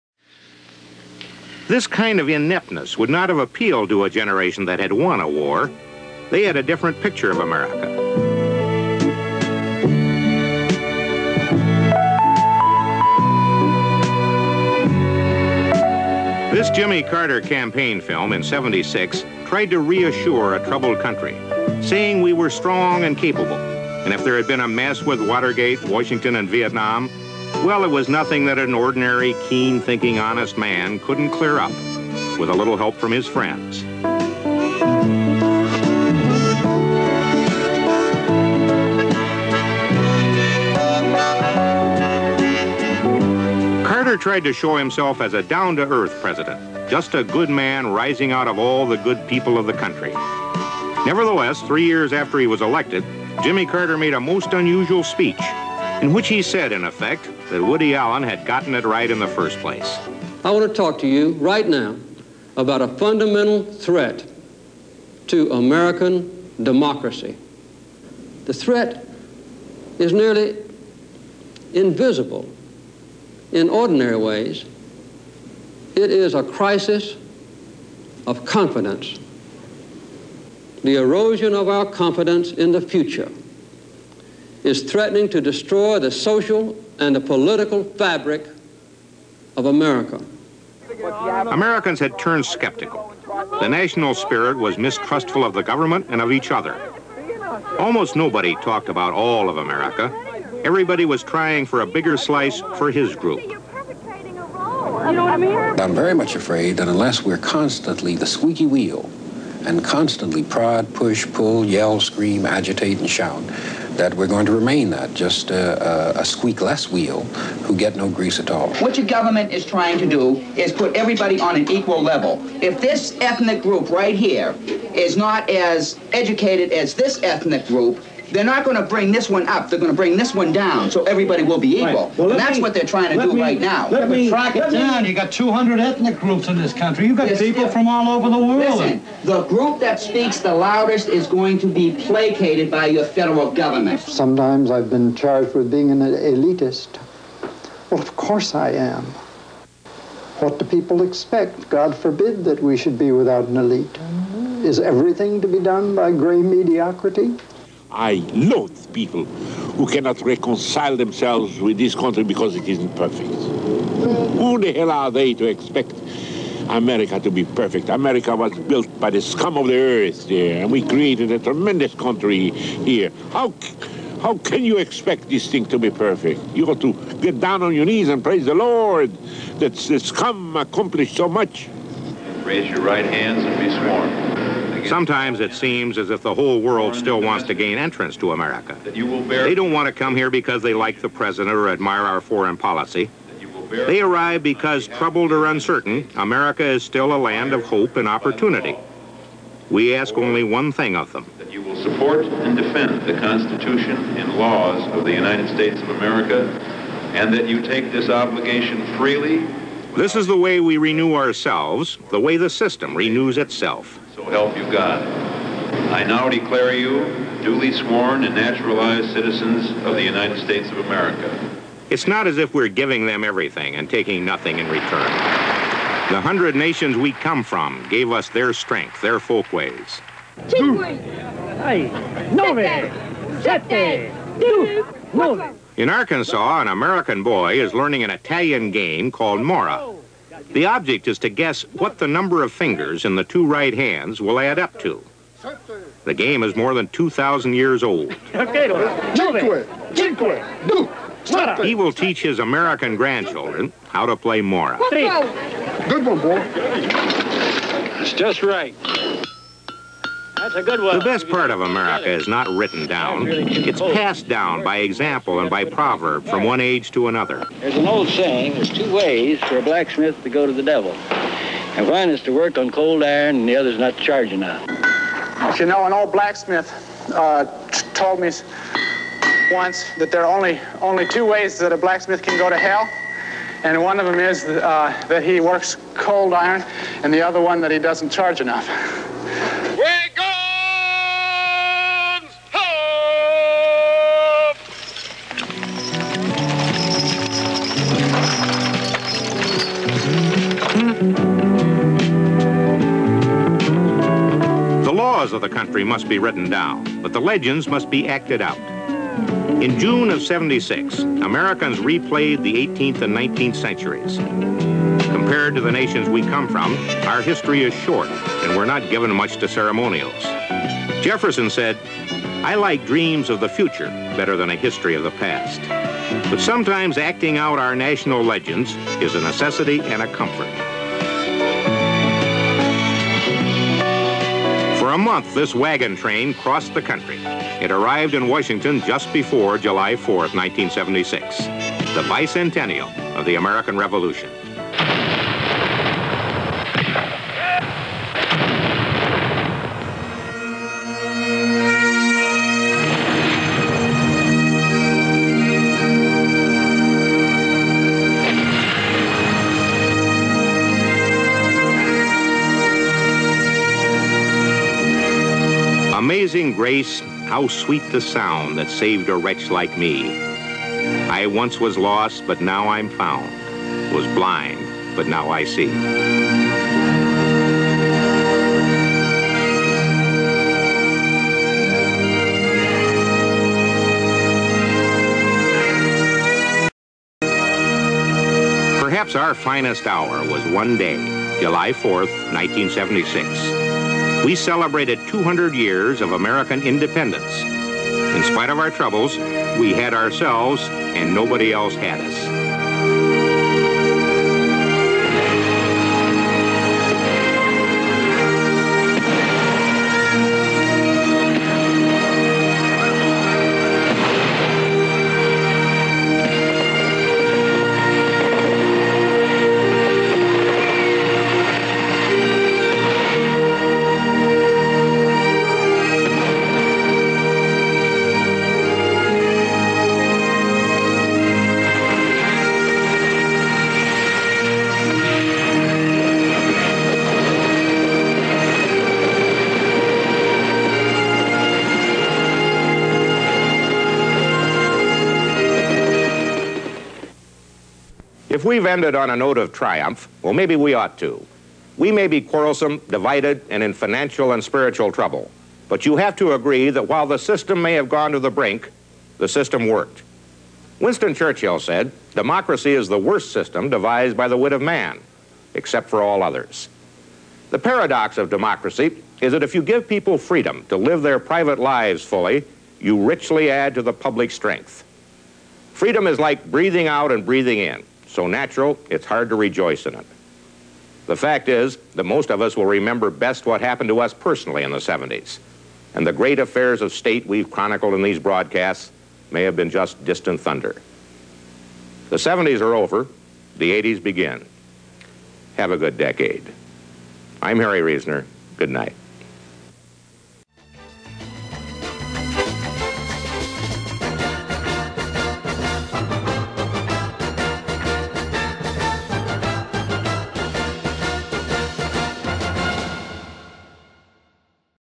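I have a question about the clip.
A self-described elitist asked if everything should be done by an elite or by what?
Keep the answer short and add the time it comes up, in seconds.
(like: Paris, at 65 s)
gray mediocrity, at 156 s.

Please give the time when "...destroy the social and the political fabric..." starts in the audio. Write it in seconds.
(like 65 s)
85 s.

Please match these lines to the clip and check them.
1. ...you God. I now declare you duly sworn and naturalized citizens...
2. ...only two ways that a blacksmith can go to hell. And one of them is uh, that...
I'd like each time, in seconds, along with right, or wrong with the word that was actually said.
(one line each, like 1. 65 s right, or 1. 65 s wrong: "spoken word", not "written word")
1. 214 s right
2. 280 s right.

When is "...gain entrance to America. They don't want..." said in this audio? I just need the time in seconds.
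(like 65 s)
187 s.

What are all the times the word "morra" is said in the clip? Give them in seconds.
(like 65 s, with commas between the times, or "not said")
239 s, 254 s.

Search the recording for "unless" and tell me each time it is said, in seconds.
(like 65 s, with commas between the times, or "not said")
106 s.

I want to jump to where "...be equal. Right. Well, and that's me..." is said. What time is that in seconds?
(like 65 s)
131 s.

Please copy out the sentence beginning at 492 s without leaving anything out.
The 70s are over, the 80s begin.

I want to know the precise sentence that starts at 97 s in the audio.
Almost nobody talked about all of America.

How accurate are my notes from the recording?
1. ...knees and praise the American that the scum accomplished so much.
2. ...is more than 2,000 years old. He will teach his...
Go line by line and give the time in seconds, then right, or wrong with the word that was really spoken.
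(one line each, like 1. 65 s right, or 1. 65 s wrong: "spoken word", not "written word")
1. 177 s wrong: "Lord", not "American"
2. 246 s right.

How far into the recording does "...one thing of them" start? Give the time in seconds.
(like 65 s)
200 s.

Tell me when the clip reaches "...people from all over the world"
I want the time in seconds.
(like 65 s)
137 s.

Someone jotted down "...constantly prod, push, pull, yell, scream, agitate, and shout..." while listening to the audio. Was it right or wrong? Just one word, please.
right.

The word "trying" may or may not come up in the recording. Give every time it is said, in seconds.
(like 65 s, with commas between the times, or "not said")
101 s, 119 s, 132 s.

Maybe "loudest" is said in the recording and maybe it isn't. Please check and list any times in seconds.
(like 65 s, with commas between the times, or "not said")
140 s.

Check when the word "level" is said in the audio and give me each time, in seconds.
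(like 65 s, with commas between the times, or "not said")
122 s.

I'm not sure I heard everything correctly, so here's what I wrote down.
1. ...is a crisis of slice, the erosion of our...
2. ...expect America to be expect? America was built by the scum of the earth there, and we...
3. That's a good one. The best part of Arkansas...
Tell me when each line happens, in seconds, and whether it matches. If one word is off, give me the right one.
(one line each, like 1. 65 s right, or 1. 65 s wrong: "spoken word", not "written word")
1. 76 s wrong: "confidence", not "slice"
2. 165 s wrong: "perfect", not "expect"
3. 260 s wrong: "America", not "Arkansas".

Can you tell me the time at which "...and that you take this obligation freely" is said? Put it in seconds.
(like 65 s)
207 s.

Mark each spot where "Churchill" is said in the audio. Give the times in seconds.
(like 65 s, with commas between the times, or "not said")
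461 s.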